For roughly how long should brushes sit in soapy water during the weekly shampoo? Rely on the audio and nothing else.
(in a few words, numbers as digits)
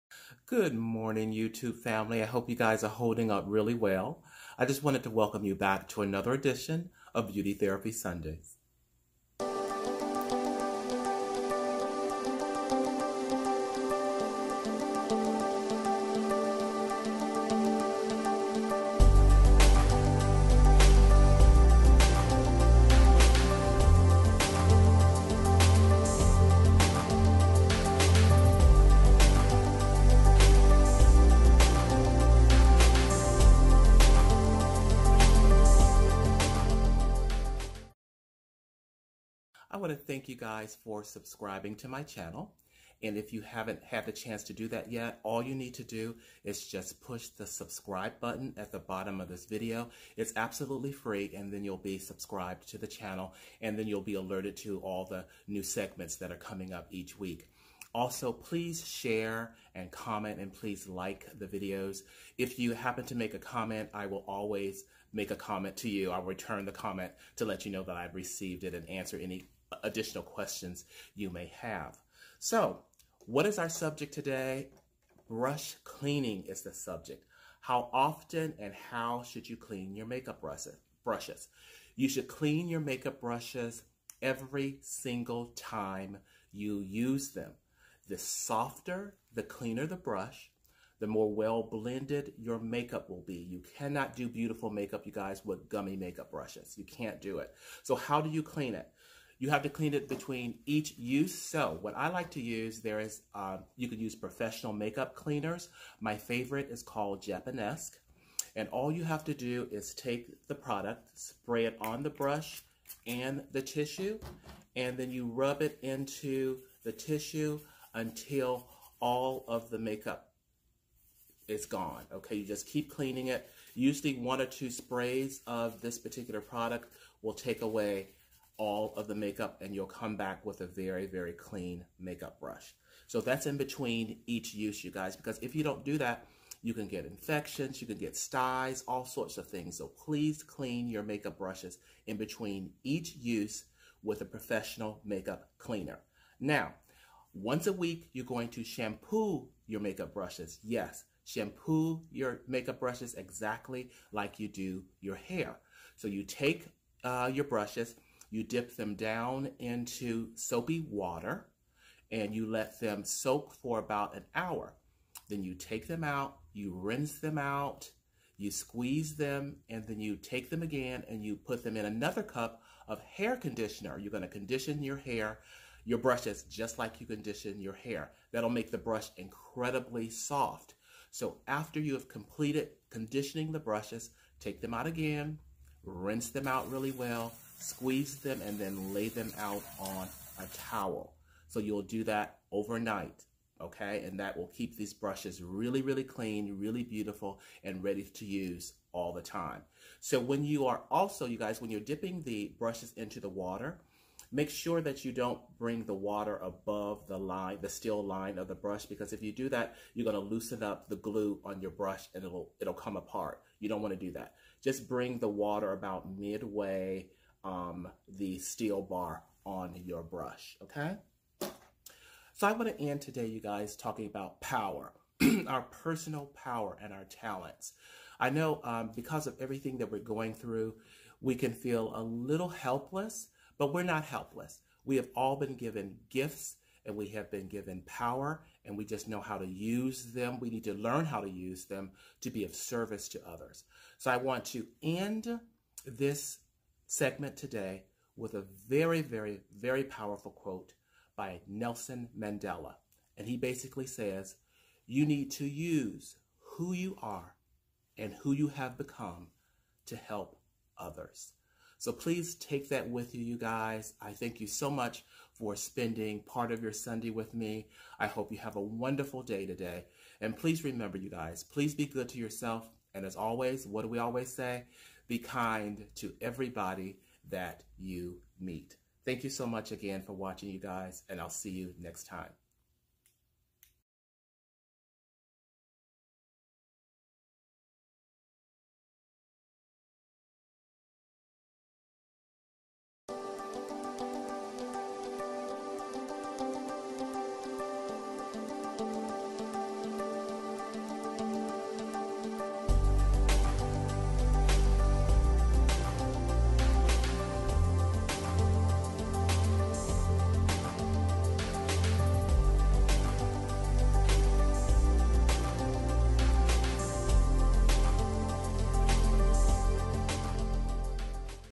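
About an hour.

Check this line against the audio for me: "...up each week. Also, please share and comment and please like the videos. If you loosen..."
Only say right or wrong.
wrong.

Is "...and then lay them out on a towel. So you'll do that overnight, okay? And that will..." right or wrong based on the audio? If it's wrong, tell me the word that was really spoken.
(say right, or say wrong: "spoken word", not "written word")
right.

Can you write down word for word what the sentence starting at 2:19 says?
So please clean your makeup brushes in between each use with a professional makeup cleaner.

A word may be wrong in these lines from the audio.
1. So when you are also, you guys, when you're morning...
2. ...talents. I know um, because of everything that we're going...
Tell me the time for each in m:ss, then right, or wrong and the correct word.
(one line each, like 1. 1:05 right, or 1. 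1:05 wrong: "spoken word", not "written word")
1. 3:19 wrong: "dipping", not "morning"
2. 3:47 right.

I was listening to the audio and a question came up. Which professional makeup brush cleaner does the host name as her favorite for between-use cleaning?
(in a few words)
Japanesque.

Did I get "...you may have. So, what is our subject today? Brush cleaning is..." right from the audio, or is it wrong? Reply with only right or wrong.
right.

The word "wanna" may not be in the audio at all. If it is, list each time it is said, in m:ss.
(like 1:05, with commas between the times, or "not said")
3:33, 3:42.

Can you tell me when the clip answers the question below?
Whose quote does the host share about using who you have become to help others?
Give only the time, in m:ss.
4:11.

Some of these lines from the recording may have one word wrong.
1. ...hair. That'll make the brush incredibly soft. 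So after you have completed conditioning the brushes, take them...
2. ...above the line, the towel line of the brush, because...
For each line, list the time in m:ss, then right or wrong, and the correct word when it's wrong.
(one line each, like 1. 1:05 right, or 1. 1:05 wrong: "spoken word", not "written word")
1. 2:57 right
2. 3:26 wrong: "steel", not "towel".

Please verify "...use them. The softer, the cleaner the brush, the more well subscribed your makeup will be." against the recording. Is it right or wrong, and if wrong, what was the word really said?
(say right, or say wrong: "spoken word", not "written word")
wrong: "blended", not "subscribed".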